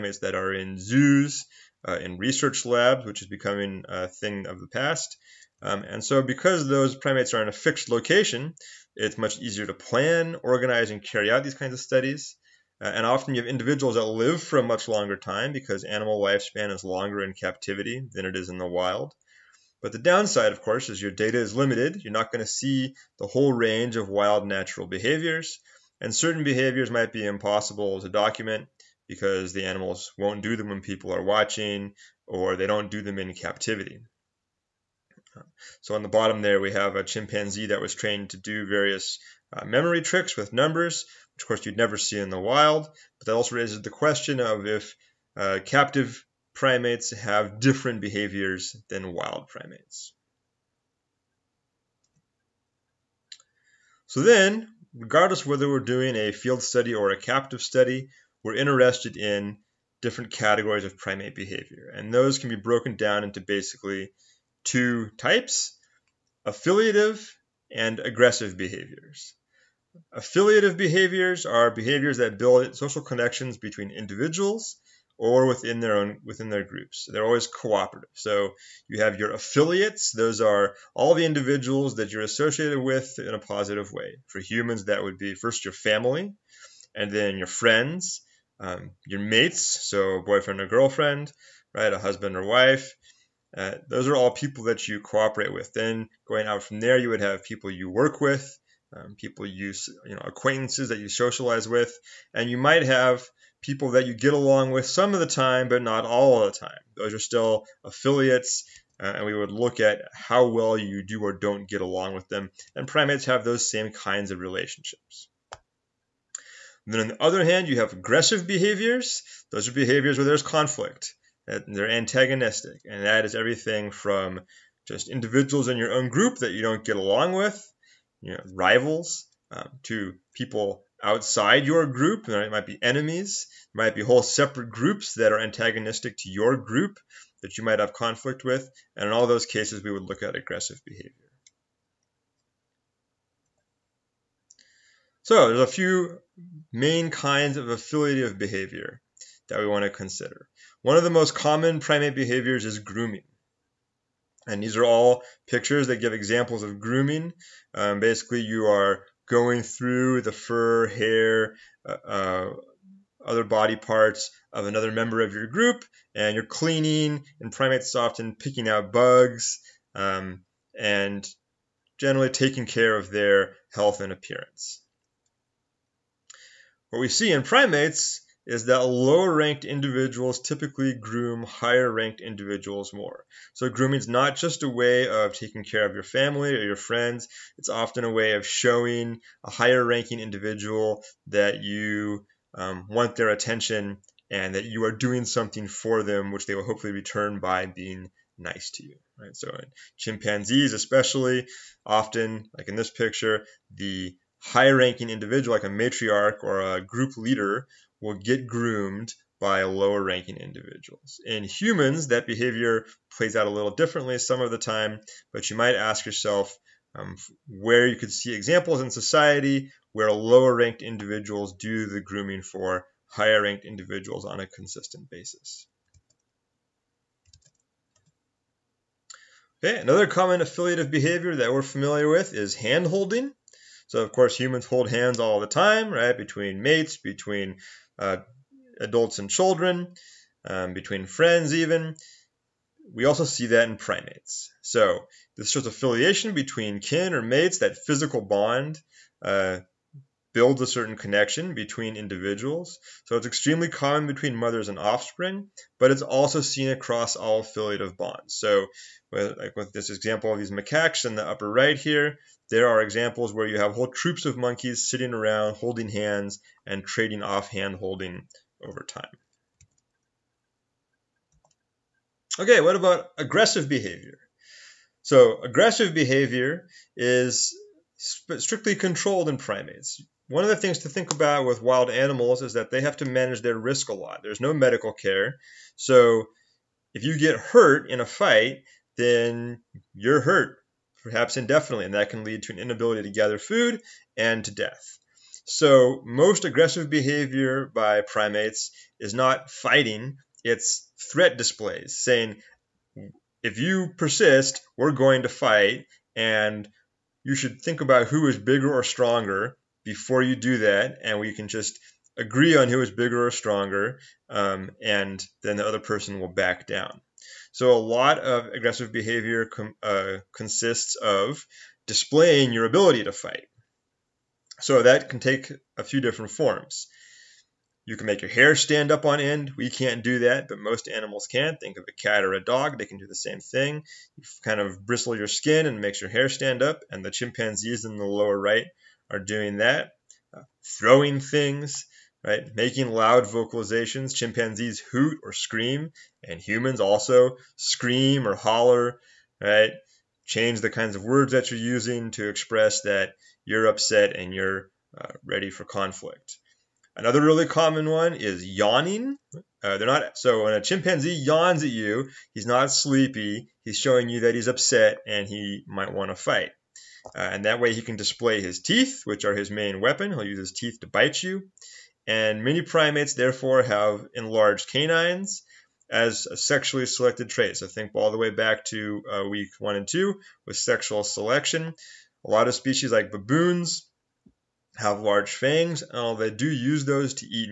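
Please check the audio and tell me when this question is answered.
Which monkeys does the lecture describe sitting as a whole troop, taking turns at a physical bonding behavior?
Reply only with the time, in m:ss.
4:20.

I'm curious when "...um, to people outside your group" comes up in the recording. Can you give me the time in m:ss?
2:09.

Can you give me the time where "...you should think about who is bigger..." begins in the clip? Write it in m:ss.
5:07.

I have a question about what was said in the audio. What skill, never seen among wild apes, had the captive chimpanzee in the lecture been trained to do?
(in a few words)
memory tricks with numbers.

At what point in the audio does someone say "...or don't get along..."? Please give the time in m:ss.
1:51.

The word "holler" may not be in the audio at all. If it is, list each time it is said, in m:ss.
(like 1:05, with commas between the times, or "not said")
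5:48.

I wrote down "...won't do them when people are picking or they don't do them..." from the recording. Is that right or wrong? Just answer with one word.
wrong.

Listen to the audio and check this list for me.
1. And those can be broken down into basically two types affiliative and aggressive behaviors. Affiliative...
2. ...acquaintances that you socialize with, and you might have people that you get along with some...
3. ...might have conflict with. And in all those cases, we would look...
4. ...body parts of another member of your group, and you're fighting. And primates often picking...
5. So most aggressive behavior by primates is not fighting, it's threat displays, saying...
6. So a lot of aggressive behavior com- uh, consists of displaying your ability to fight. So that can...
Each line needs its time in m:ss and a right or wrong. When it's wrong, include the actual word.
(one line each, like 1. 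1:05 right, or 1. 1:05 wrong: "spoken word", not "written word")
1. 1:01 right
2. 1:40 right
3. 2:17 right
4. 2:43 wrong: "cleaning", not "fighting"
5. 4:55 right
6. 5:17 right.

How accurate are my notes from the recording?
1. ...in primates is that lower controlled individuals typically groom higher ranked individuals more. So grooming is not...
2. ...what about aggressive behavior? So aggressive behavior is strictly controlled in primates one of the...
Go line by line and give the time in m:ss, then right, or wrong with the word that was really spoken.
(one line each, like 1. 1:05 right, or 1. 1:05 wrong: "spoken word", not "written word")
1. 2:57 wrong: "ranked", not "controlled"
2. 4:32 right.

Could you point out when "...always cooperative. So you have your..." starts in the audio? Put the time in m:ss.
1:17.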